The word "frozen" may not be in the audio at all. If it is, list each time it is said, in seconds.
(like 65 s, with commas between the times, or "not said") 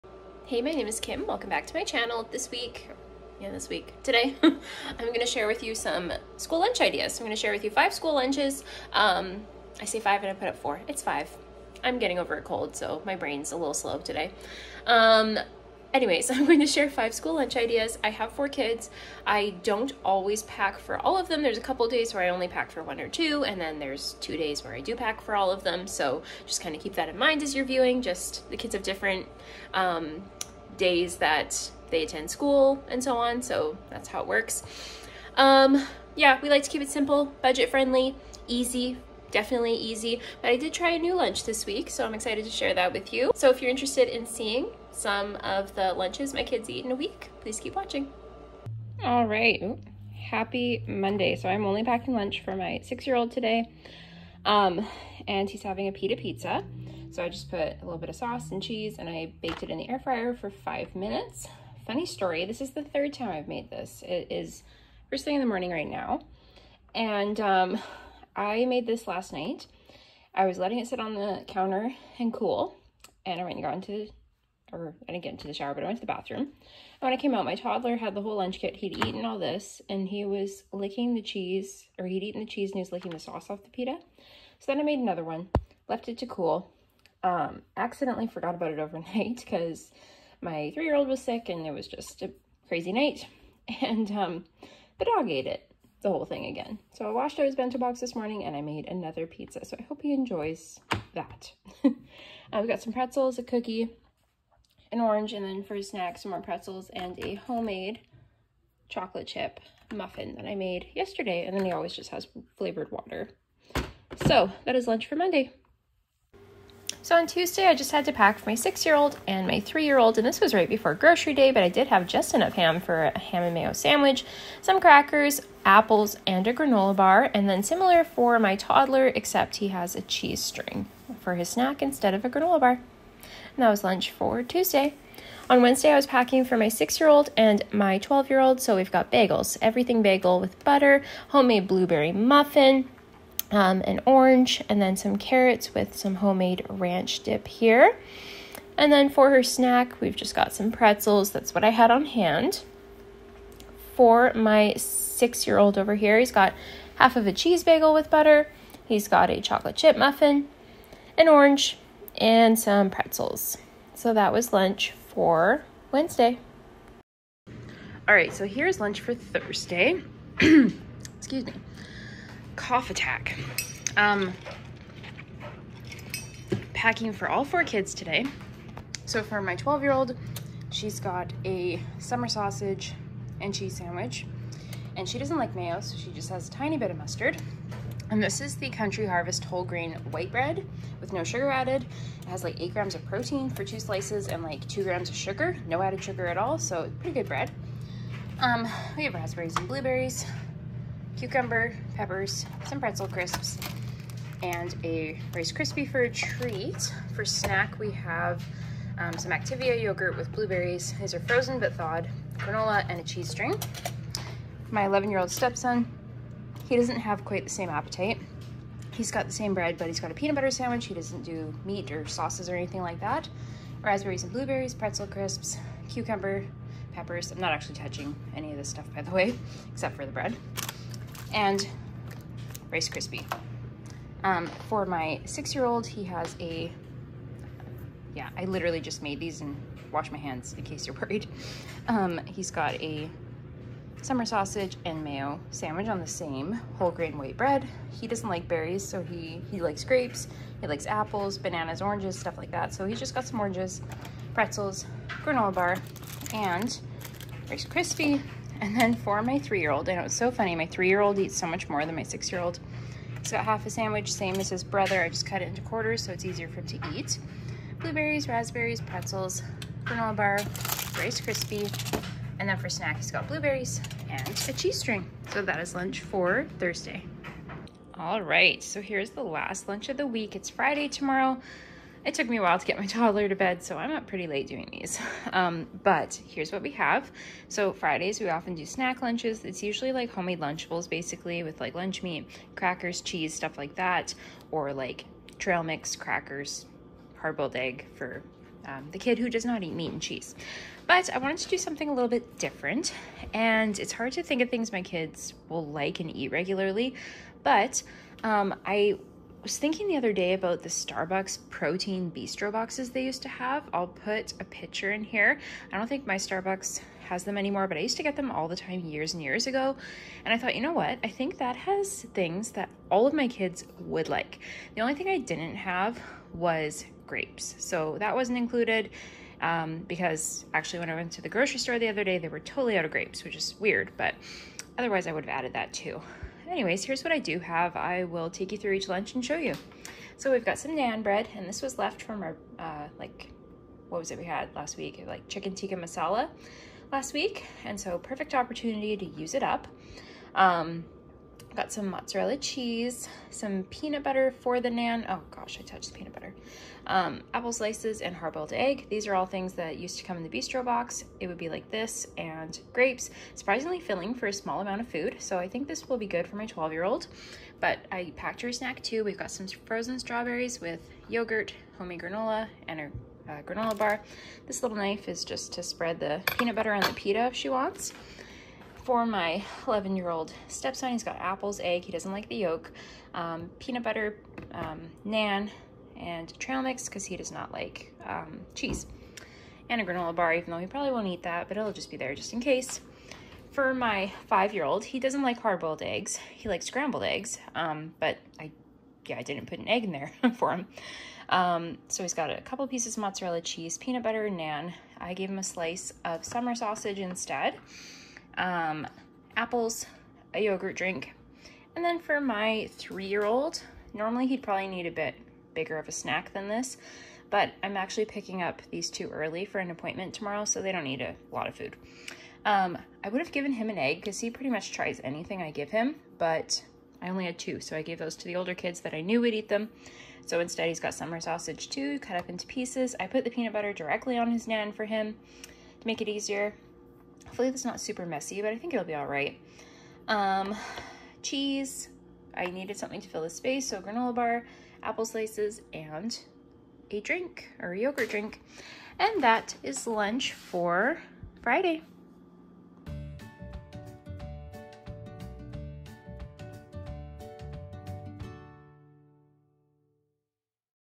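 211 s, 369 s.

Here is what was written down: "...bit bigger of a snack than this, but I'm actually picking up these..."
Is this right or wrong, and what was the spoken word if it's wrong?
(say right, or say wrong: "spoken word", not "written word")
right.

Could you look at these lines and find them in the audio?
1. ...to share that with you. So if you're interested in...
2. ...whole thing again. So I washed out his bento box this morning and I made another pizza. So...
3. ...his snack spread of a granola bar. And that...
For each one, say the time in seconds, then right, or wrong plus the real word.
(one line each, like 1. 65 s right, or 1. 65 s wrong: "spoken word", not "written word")
1. 42 s right
2. 96 s right
3. 131 s wrong: "instead", not "spread".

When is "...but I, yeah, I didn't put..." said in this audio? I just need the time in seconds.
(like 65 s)
398 s.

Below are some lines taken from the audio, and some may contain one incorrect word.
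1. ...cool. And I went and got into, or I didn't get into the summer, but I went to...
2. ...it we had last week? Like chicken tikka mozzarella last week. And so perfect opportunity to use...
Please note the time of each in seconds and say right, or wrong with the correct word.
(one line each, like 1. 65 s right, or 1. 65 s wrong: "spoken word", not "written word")
1. 72 s wrong: "shower", not "summer"
2. 344 s wrong: "masala", not "mozzarella".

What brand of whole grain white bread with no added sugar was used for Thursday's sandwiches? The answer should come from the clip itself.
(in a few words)
Country Harvest.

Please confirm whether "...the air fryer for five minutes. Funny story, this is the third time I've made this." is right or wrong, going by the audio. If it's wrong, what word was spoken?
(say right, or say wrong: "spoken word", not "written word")
right.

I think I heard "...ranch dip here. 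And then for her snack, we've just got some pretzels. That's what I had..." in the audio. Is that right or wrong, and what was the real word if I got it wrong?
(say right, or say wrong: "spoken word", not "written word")
right.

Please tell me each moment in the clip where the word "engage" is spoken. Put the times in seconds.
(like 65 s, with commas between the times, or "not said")
not said.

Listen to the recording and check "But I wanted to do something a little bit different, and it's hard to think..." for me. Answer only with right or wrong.
right.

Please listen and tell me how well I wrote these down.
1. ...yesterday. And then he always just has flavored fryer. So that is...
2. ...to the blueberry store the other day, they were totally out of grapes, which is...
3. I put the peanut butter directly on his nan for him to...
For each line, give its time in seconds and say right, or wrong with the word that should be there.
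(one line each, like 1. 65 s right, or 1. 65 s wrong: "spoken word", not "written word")
1. 110 s wrong: "water", not "fryer"
2. 331 s wrong: "grocery", not "blueberry"
3. 432 s right.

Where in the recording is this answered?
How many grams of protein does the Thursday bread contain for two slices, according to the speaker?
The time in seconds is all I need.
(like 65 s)
192 s.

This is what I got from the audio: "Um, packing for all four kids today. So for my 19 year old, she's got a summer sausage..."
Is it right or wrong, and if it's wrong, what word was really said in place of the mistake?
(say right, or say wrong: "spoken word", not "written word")
wrong: "12", not "19".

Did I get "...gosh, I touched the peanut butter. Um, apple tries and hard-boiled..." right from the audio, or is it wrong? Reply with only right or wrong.
wrong.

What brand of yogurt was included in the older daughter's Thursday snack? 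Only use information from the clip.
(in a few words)
Activia.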